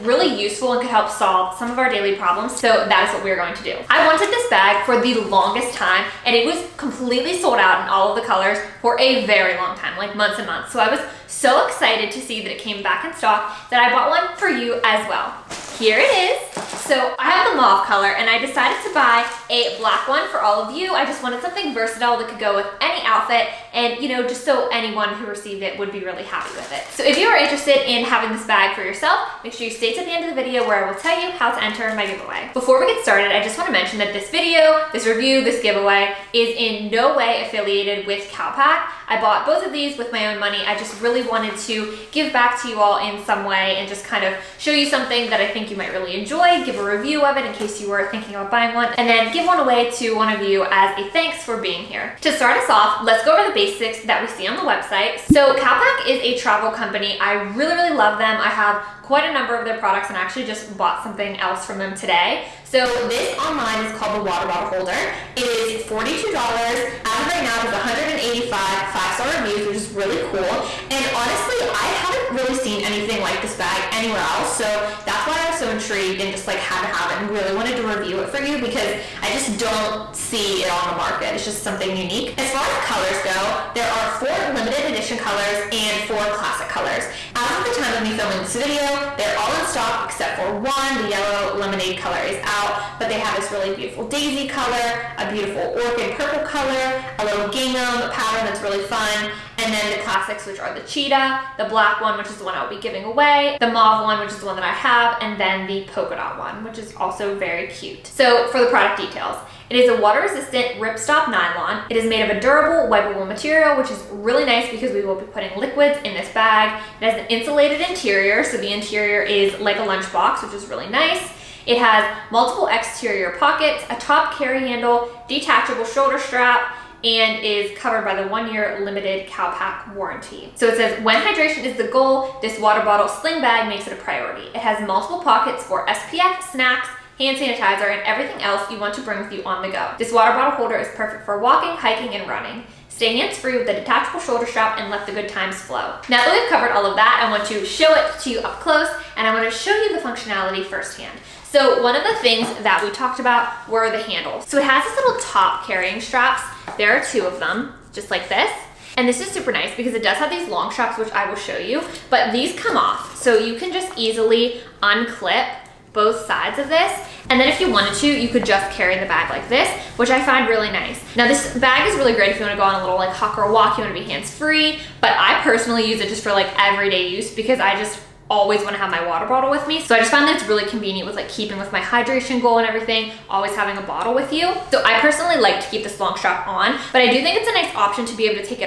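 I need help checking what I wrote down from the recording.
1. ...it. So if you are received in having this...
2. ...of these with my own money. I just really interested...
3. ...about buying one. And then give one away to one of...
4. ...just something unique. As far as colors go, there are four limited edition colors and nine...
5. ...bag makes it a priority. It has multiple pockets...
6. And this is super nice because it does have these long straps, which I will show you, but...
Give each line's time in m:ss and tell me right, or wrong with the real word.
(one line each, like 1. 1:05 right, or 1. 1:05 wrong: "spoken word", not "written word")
1. 0:26 wrong: "interested", not "received"
2. 0:39 wrong: "wanted", not "interested"
3. 0:48 right
4. 1:21 wrong: "four", not "nine"
5. 2:13 right
6. 2:38 right.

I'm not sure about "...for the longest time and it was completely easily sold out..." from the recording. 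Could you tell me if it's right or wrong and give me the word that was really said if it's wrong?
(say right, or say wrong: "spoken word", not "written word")
wrong: "completely", not "easily".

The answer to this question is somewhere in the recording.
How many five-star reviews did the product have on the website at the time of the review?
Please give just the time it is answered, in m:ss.
1:07.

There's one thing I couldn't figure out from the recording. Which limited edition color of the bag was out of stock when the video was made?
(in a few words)
Yellow lemonade.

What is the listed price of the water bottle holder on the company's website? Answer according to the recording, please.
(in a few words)
$42.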